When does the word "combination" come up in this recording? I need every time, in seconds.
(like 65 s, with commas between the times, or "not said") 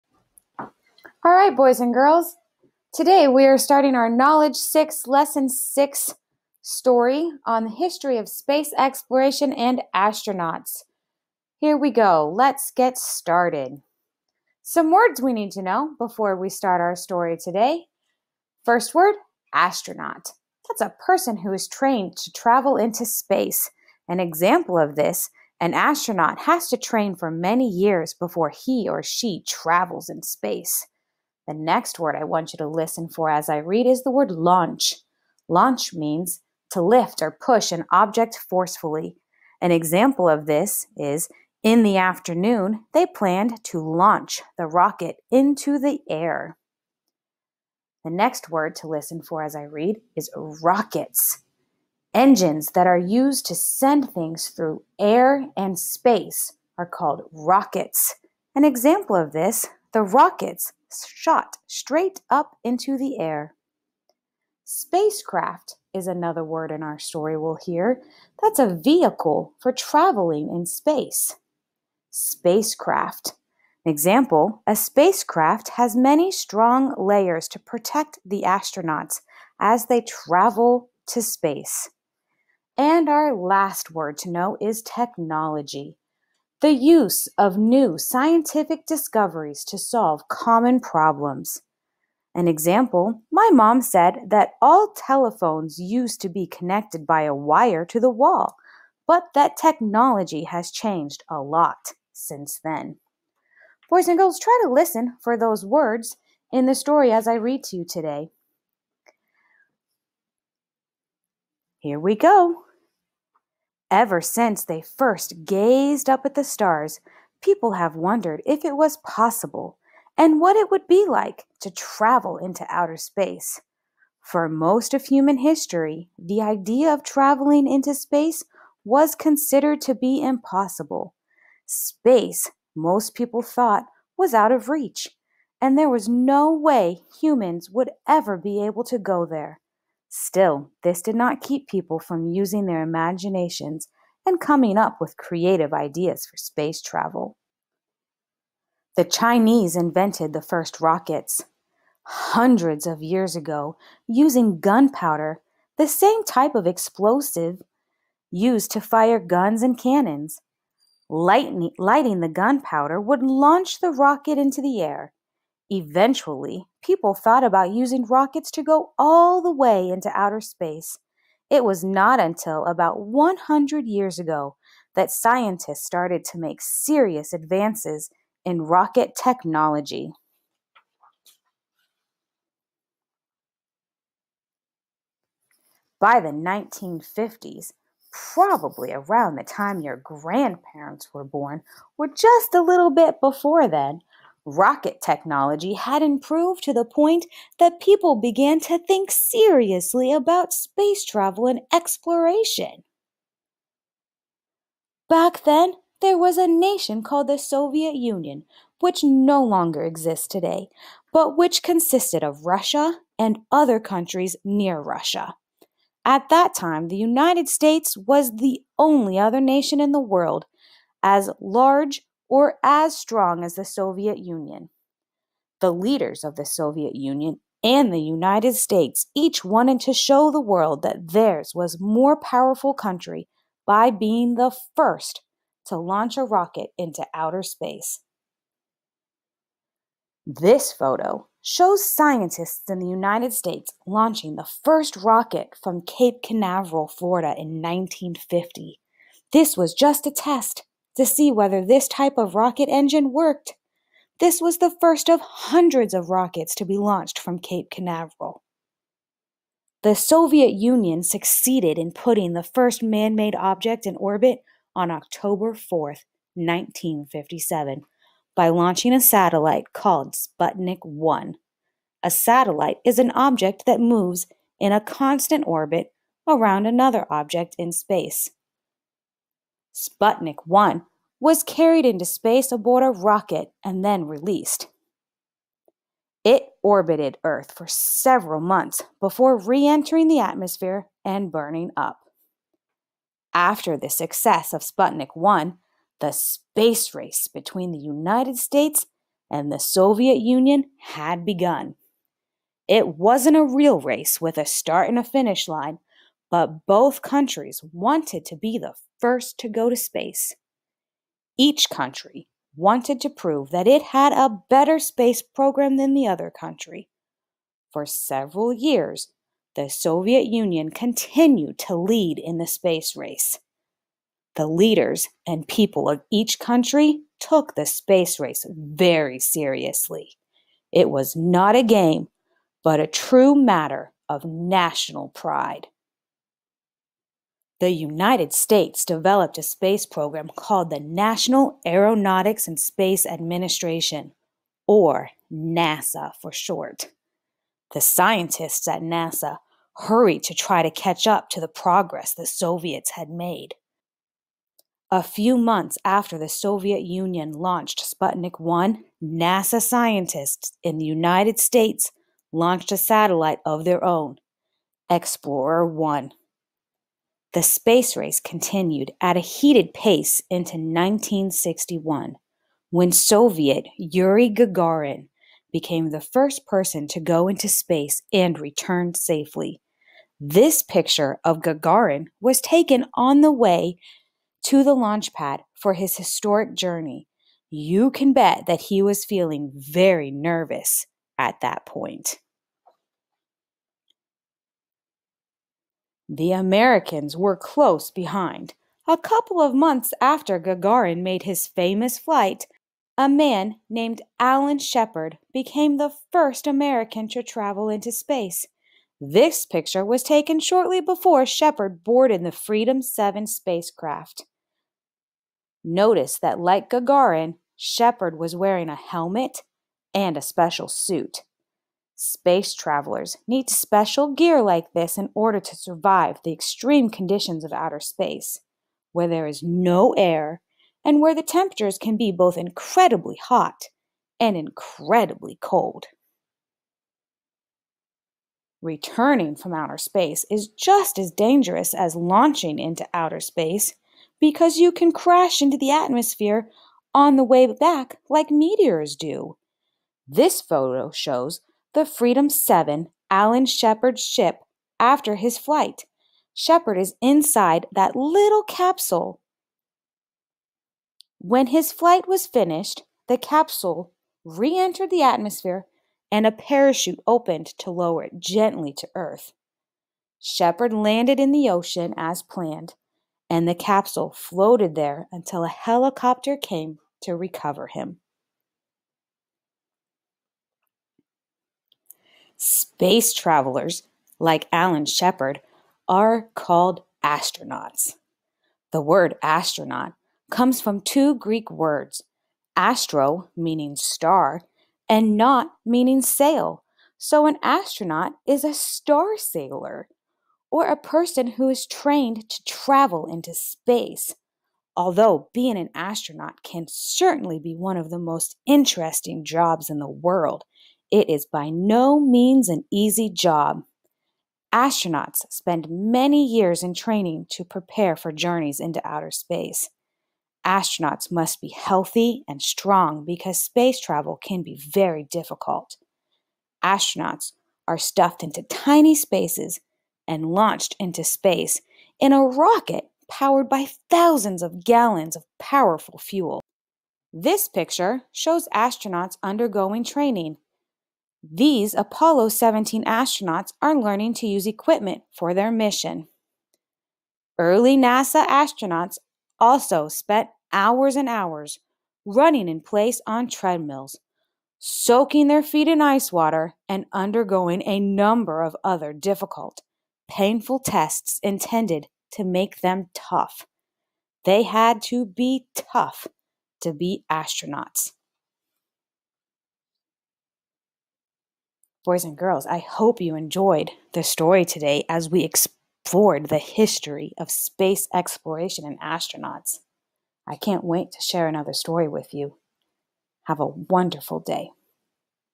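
not said.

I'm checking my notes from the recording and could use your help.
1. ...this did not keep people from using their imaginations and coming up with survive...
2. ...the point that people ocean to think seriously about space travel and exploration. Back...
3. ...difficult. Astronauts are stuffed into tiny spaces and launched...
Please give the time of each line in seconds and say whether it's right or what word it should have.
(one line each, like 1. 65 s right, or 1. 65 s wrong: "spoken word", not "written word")
1. 140 s wrong: "creative", not "survive"
2. 196 s wrong: "began", not "ocean"
3. 525 s right.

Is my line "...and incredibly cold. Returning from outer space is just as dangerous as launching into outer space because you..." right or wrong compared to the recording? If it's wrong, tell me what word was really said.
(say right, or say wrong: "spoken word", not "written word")
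right.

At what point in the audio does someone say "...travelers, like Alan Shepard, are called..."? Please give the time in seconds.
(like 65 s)
483 s.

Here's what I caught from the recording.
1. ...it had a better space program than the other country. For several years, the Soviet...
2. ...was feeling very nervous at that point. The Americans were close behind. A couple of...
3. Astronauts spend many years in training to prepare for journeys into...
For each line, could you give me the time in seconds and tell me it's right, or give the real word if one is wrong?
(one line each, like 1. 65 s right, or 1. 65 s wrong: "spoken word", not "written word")
1. 313 s right
2. 388 s right
3. 514 s right.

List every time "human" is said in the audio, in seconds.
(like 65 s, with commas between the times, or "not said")
125 s, 137 s.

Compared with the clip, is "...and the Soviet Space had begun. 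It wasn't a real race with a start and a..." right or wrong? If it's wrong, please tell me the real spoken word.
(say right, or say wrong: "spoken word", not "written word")
wrong: "Union", not "Space".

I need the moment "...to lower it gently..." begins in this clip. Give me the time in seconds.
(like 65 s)
467 s.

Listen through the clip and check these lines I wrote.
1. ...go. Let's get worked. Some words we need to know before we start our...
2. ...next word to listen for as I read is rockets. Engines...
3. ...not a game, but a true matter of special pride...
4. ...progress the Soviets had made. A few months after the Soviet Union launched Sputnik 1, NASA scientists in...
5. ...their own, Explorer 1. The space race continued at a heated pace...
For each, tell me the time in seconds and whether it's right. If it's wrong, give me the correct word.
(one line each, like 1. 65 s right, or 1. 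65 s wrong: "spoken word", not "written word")
1. 11 s wrong: "started", not "worked"
2. 48 s right
3. 331 s wrong: "national", not "special"
4. 351 s right
5. 363 s right.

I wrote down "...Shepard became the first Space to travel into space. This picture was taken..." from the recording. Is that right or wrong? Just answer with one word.
wrong.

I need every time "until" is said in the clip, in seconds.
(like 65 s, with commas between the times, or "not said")
172 s, 475 s.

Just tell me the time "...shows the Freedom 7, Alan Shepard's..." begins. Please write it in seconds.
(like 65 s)
450 s.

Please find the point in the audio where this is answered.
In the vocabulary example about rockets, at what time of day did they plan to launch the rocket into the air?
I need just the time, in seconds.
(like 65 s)
41 s.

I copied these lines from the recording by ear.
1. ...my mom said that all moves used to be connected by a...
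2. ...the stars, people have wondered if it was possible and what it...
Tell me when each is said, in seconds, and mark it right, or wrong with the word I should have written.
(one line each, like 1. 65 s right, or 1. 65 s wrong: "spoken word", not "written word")
1. 93 s wrong: "telephones", not "moves"
2. 116 s right.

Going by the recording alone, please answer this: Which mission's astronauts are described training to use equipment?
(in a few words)
Apollo 17.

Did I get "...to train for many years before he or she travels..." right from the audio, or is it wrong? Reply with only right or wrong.
right.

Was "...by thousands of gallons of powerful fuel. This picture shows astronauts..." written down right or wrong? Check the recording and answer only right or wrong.
right.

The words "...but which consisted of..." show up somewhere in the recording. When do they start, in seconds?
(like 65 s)
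211 s.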